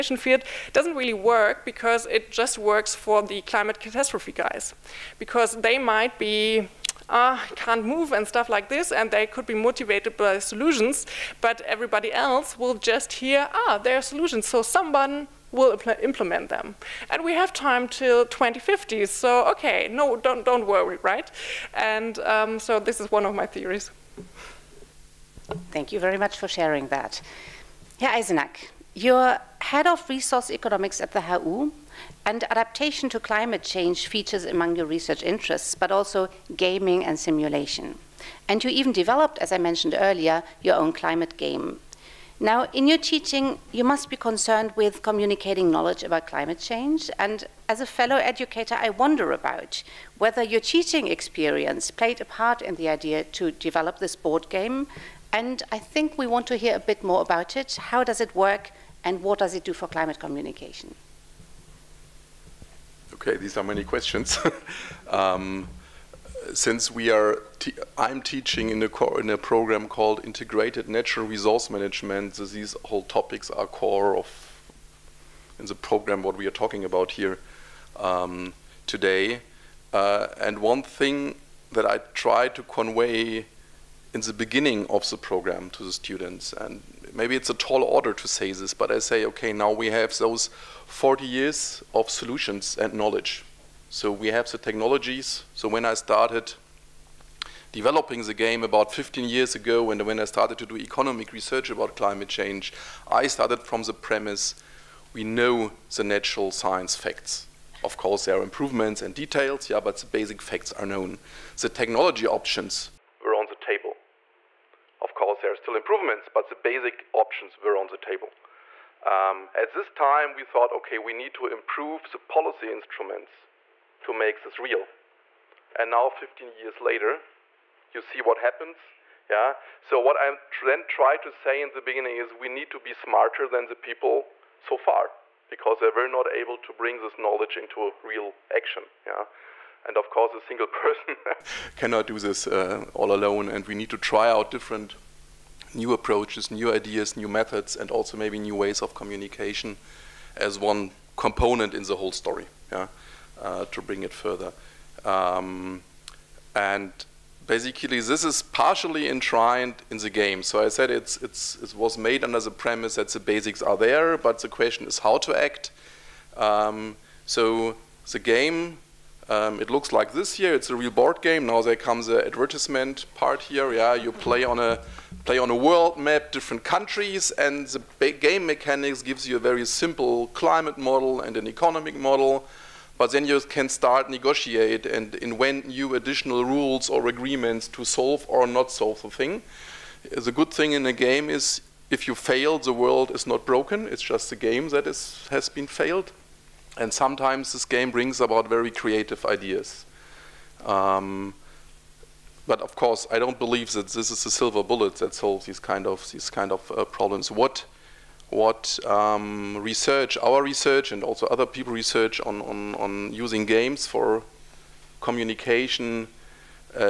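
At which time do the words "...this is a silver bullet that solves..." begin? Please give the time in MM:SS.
03:23.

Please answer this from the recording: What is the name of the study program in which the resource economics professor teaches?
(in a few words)
Integrated Natural Resource Management.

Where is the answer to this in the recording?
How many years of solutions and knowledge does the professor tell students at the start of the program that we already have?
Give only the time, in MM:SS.
01:30.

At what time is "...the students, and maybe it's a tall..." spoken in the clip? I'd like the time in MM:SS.
01:25.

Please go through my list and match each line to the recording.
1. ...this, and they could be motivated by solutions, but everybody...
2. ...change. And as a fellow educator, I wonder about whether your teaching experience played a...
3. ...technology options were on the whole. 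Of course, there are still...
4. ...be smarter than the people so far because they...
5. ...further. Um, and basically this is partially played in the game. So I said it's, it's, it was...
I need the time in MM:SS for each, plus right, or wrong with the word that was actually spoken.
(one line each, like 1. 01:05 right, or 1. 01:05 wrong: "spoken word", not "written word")
1. 00:08 right
2. 00:46 right
3. 01:51 wrong: "table", not "whole"
4. 02:12 right
5. 02:34 wrong: "enshrined", not "played".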